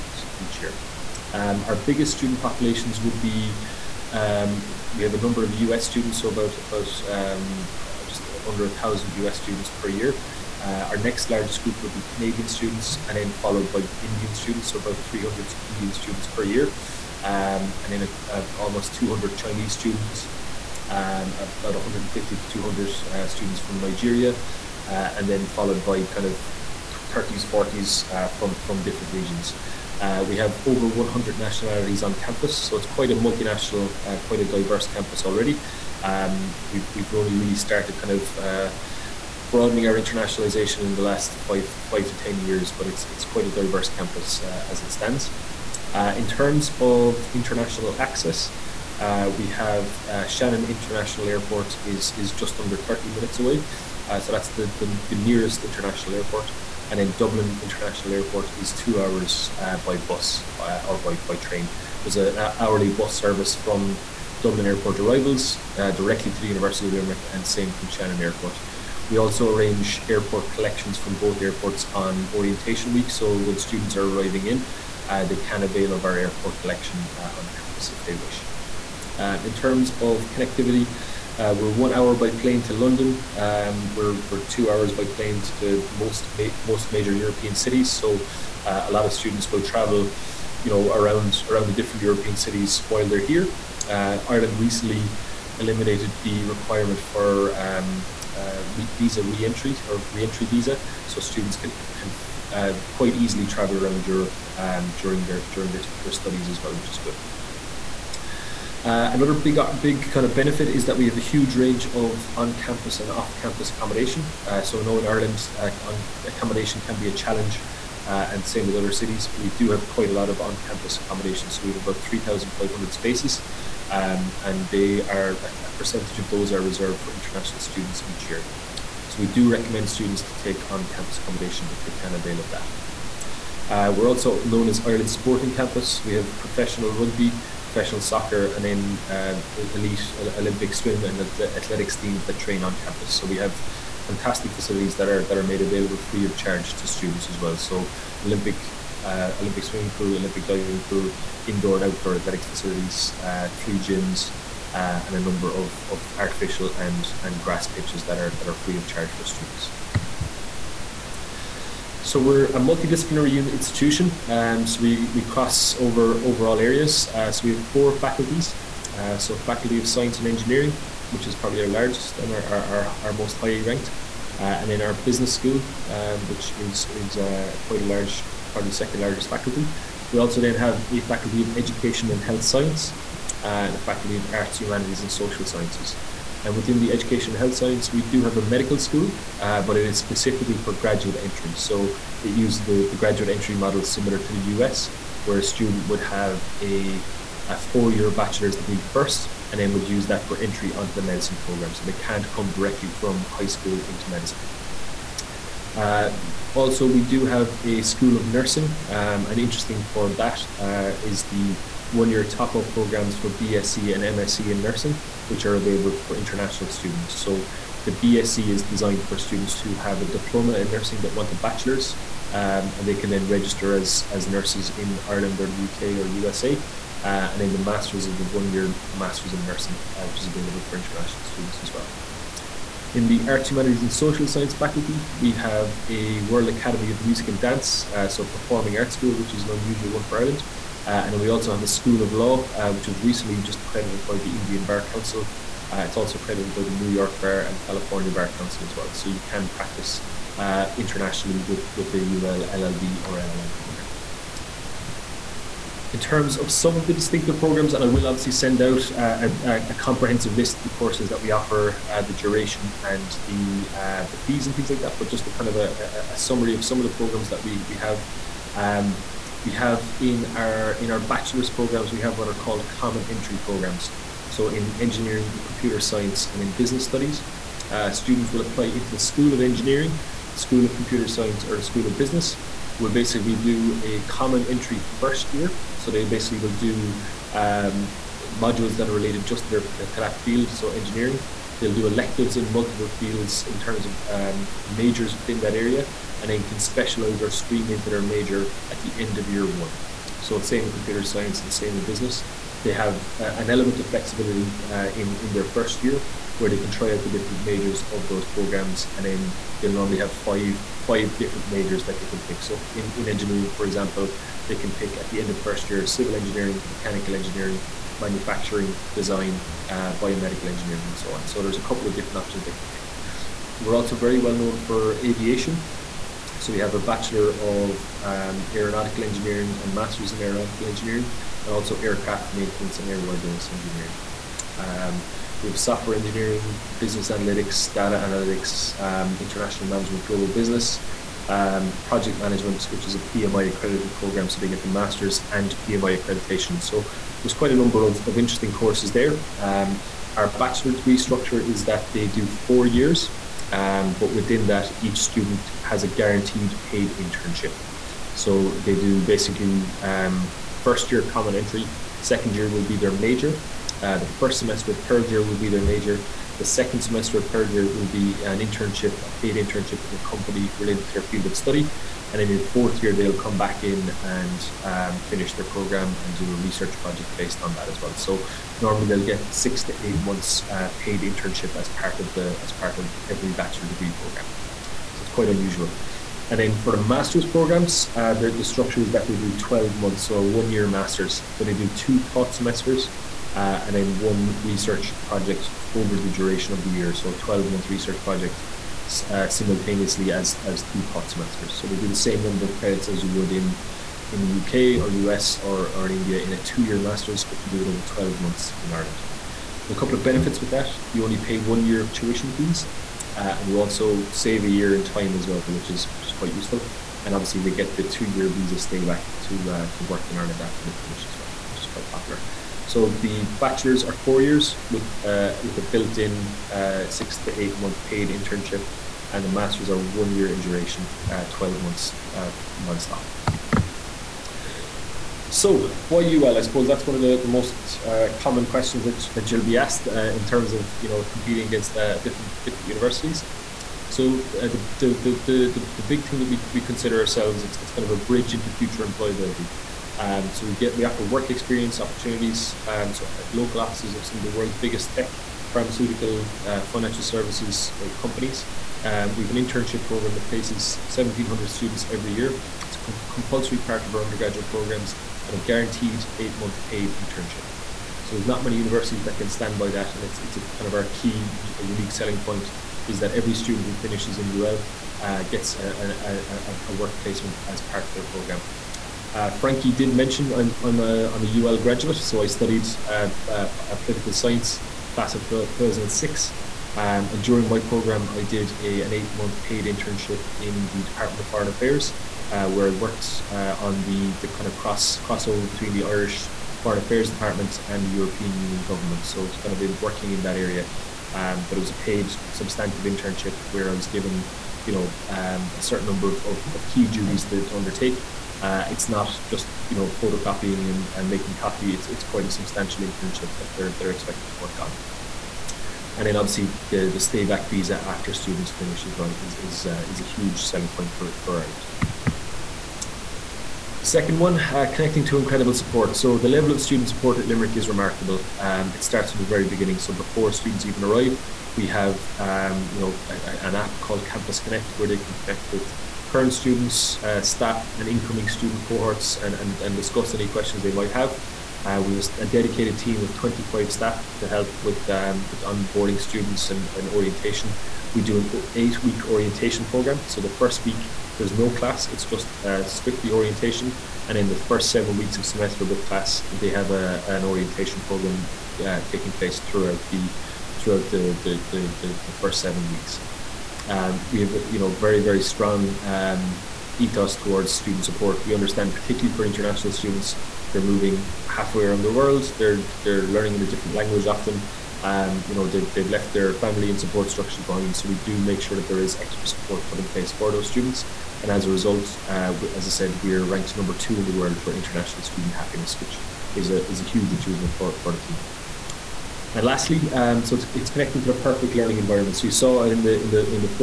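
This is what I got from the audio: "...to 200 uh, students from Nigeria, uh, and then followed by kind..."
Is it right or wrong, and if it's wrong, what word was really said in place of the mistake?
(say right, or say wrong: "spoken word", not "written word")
right.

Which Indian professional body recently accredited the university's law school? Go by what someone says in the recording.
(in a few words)
Indian Bar Council.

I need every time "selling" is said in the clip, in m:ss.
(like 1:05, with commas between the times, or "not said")
7:51, 8:40.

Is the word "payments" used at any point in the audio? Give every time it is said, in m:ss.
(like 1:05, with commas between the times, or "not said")
not said.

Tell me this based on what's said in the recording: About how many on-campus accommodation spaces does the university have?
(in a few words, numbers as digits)
3,500.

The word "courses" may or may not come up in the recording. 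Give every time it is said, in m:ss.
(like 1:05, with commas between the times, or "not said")
4:20, 5:48.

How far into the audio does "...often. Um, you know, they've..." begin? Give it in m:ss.
9:34.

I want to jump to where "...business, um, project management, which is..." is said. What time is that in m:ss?
5:40.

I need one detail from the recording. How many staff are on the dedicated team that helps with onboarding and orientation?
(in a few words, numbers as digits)
25.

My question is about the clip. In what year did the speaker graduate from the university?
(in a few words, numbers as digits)
2006.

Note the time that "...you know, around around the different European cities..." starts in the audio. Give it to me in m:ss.
1:30.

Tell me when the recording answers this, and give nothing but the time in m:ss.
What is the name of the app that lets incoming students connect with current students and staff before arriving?
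8:54.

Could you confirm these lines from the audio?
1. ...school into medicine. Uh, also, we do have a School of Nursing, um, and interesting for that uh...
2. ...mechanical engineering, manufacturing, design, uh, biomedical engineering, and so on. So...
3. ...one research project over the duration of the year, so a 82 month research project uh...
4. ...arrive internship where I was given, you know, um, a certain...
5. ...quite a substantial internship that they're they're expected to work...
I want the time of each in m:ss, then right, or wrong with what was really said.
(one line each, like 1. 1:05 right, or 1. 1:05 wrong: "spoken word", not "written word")
1. 3:23 right
2. 5:16 right
3. 6:33 wrong: "12", not "82"
4. 8:22 wrong: "substantive", not "arrive"
5. 8:32 right.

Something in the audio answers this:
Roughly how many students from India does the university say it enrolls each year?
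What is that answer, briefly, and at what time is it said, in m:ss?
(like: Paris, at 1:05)
300, at 0:14.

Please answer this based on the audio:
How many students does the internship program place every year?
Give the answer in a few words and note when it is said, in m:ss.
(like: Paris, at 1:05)
1,700, at 7:40.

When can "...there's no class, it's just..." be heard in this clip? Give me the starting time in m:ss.
9:11.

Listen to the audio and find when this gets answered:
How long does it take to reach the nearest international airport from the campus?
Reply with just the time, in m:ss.
0:52.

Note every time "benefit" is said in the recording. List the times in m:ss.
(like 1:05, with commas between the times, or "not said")
1:50, 6:50.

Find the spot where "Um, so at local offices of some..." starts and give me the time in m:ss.
7:32.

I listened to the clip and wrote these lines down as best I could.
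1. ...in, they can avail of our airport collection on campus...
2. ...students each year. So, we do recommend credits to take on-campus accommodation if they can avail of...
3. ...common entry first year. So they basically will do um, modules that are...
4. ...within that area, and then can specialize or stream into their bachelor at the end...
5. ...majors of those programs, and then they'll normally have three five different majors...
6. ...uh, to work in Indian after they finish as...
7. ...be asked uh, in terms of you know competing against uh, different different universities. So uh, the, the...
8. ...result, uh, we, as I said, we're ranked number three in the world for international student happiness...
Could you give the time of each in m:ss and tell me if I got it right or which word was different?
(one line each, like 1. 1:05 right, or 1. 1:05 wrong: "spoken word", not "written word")
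1. 1:14 right
2. 2:07 wrong: "students", not "credits"
3. 4:44 right
4. 4:55 wrong: "major", not "bachelor"
5. 5:07 wrong: "five", not "three"
6. 6:59 wrong: "Ireland", not "Indian"
7. 7:19 right
8. 9:41 wrong: "two", not "three".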